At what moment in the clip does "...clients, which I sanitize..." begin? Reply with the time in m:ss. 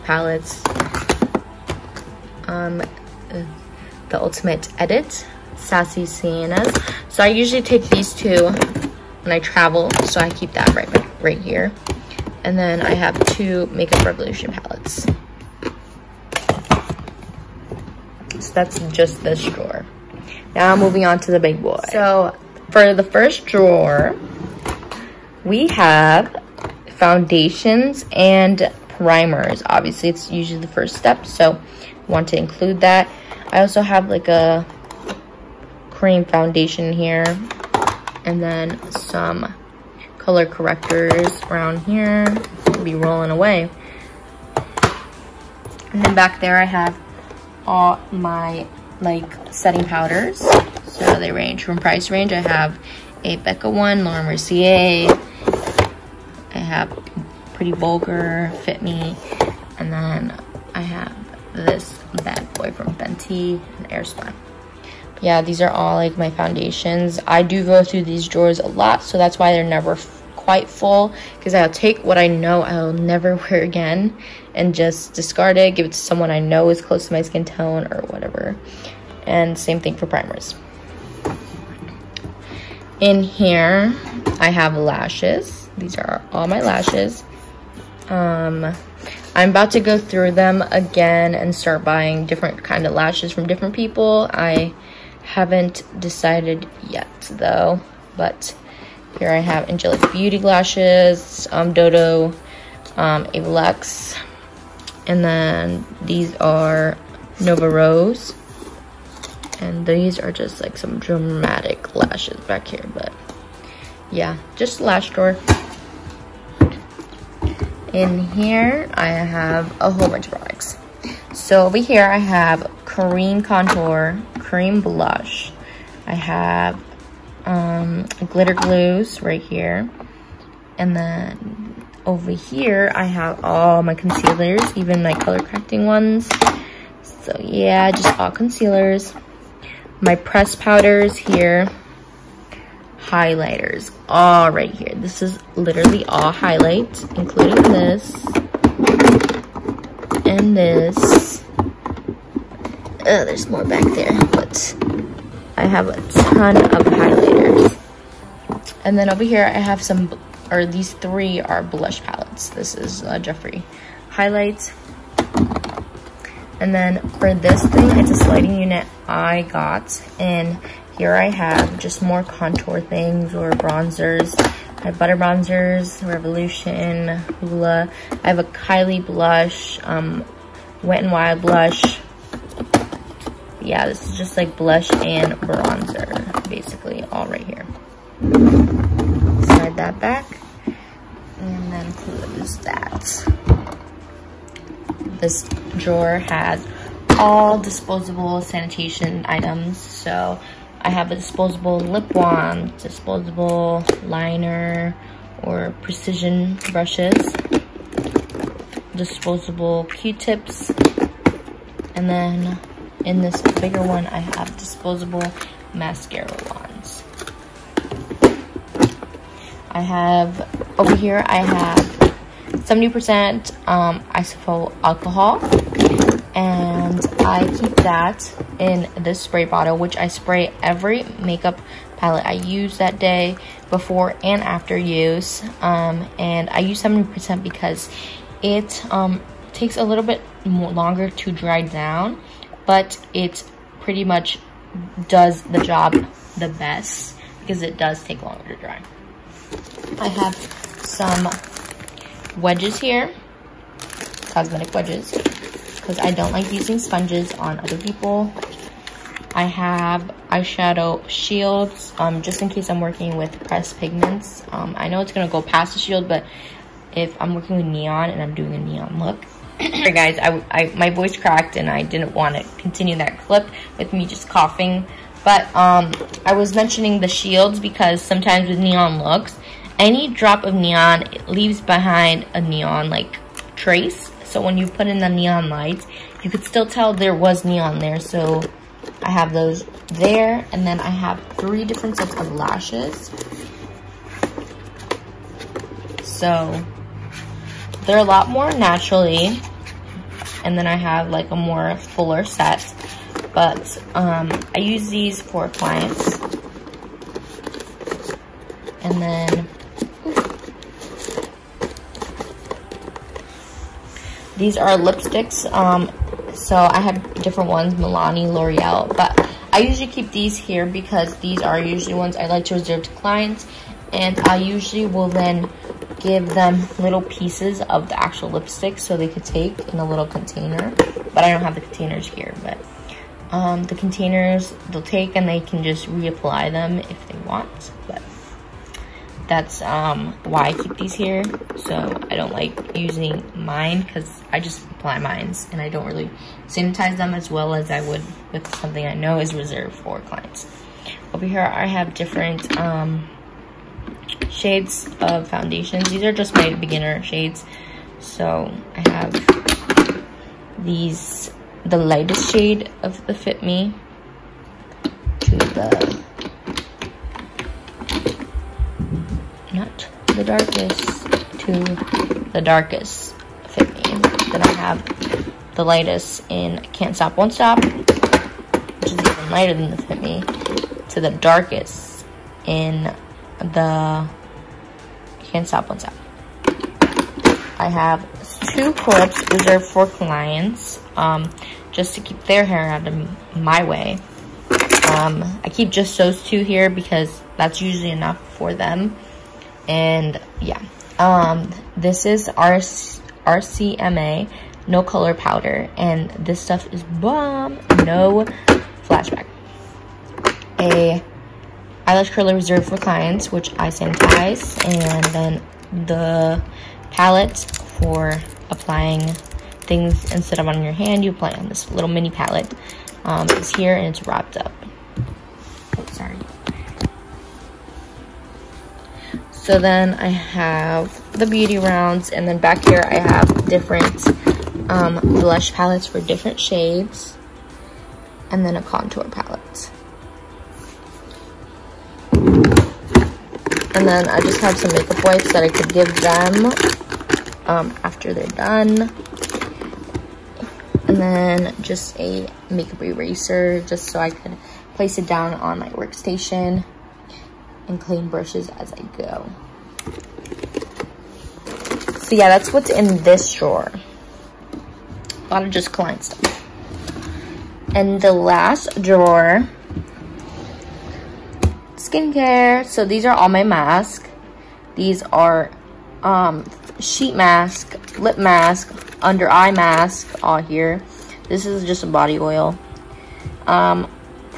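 6:52.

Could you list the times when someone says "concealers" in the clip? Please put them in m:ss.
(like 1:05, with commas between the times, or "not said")
2:13, 2:18.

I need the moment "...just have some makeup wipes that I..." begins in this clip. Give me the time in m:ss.
7:24.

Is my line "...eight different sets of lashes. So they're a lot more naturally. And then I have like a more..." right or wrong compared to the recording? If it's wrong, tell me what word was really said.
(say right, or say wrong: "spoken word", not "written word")
wrong: "three", not "eight".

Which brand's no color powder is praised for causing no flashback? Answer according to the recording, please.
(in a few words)
RCMA.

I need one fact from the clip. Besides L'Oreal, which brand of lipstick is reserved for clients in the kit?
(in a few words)
Milani.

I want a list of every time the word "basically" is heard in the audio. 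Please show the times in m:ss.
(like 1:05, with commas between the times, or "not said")
3:06.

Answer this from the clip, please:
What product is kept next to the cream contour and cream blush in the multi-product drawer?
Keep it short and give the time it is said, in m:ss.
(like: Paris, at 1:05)
glitter glues, at 2:08.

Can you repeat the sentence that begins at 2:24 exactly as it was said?
This is literally all highlight, including this and this.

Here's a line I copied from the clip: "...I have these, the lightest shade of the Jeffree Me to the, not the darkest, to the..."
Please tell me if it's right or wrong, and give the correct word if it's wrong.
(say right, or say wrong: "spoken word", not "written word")
wrong: "Fit", not "Jeffree".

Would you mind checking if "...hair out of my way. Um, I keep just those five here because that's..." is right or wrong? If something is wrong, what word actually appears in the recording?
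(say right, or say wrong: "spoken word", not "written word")
wrong: "two", not "five".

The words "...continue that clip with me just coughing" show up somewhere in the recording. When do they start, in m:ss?
4:32.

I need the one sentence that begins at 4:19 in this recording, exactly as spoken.
I have eyeshadow shields, um, just in case I'm working with pressed pigments.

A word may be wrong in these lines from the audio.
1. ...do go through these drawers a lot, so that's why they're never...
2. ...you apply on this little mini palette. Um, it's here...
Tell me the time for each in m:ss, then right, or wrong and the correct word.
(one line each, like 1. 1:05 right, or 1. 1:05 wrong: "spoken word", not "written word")
1. 1:07 right
2. 7:01 right.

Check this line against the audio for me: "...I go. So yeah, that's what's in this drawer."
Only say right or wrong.
right.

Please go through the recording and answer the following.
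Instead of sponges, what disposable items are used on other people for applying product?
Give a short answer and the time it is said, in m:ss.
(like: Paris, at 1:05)
cosmetic wedges, at 4:14.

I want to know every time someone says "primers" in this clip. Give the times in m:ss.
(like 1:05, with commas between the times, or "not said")
0:28, 1:20.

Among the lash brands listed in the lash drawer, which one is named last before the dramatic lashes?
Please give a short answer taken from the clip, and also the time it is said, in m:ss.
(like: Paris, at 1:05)
Nova Rose, at 1:47.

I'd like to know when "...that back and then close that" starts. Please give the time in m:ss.
3:09.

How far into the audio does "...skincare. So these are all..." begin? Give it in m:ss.
7:51.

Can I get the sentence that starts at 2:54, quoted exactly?
I have Butter Bronzers, Revolution, Hoola.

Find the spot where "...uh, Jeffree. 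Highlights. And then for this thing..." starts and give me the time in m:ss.
2:43.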